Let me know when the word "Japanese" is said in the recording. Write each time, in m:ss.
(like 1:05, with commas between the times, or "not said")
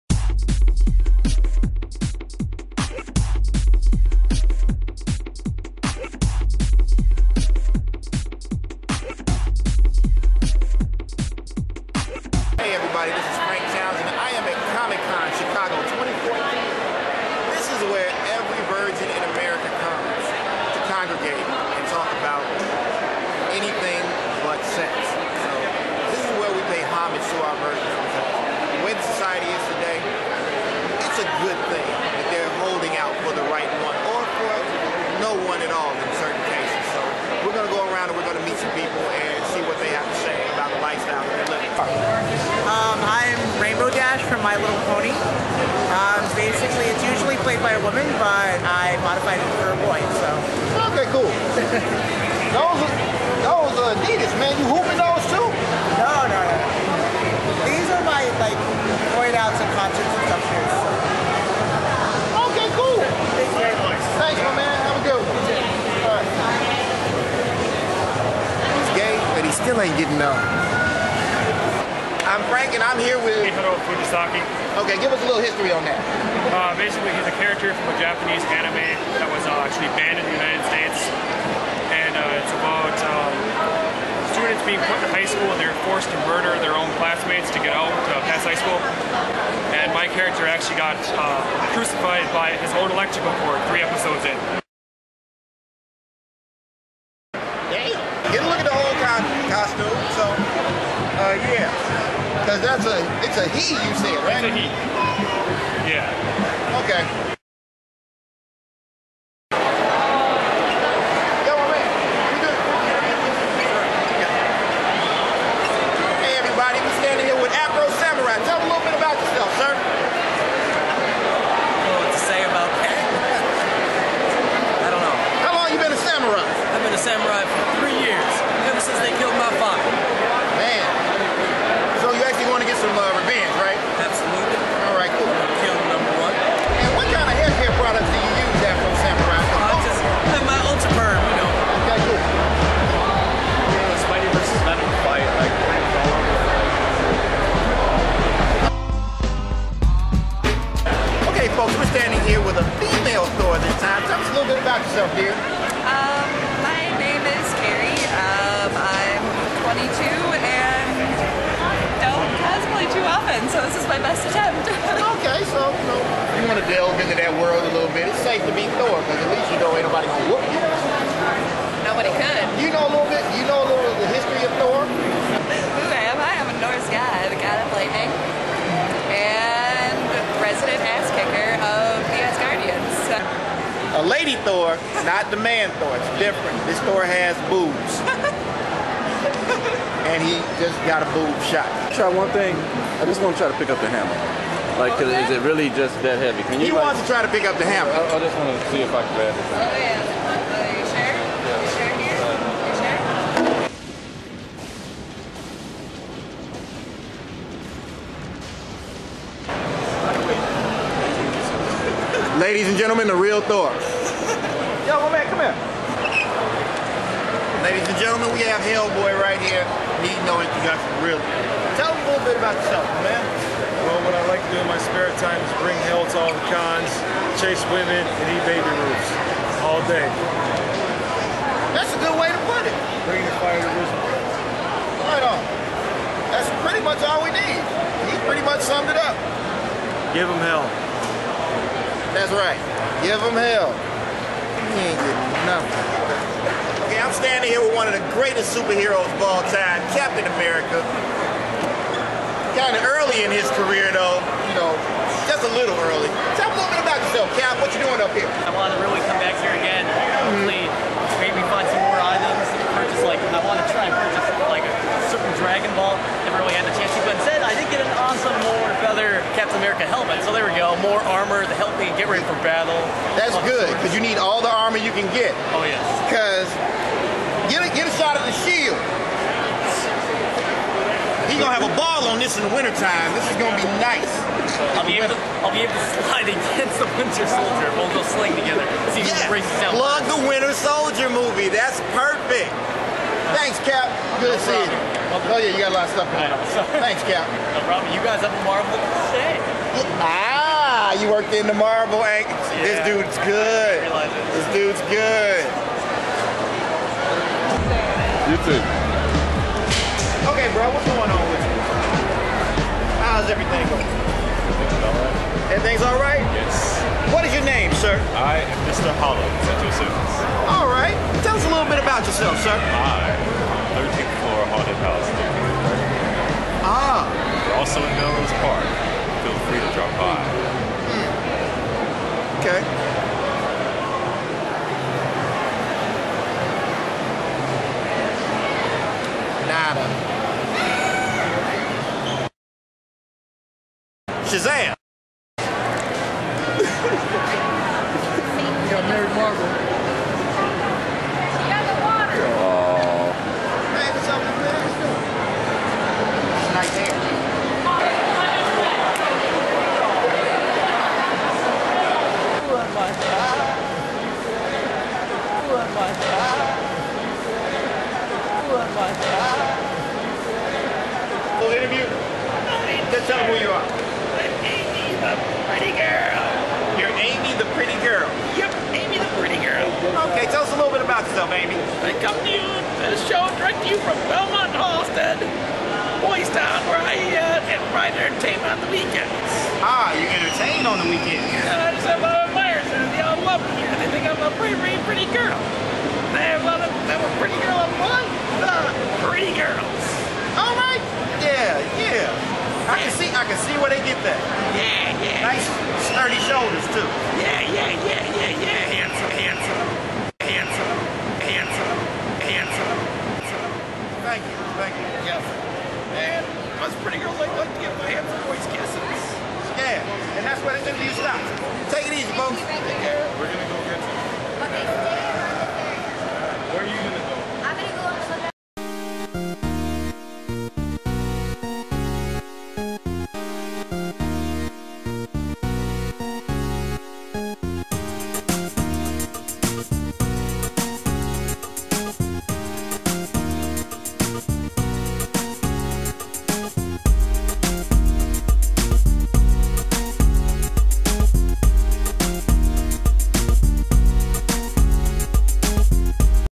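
1:18.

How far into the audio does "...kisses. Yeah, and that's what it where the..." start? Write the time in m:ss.
6:58.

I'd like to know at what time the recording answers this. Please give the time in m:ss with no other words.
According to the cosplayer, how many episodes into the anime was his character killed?
1:33.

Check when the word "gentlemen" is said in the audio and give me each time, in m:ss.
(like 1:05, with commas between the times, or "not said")
3:32, 3:38.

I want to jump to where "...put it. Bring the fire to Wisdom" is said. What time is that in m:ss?
3:52.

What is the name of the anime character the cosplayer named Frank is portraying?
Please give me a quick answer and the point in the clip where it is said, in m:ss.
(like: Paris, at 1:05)
Chihiro Fujisaki, at 1:13.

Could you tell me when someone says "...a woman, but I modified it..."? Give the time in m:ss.
0:47.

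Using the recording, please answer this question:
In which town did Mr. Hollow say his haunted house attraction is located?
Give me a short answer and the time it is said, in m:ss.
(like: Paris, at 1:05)
Melrose Park, at 5:28.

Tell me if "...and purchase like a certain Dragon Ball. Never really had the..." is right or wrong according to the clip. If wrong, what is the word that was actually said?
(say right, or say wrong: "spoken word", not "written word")
right.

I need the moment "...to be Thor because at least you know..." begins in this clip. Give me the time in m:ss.
2:48.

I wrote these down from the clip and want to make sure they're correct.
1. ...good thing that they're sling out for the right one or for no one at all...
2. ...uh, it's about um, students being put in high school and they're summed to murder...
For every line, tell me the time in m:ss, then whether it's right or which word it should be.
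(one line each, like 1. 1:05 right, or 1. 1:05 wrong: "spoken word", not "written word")
1. 0:31 wrong: "holding", not "sling"
2. 1:22 wrong: "forced", not "summed".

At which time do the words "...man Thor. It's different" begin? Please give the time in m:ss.
3:05.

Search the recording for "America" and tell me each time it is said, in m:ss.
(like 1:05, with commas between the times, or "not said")
4:10, 4:29.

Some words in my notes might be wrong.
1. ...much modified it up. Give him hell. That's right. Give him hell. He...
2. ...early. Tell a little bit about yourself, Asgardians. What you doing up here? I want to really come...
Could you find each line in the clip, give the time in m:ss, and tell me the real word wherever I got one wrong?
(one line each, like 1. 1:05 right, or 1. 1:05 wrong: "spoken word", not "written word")
1. 3:58 wrong: "summed", not "modified"
2. 4:15 wrong: "Cap", not "Asgardians".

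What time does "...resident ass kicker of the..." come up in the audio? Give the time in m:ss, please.
3:00.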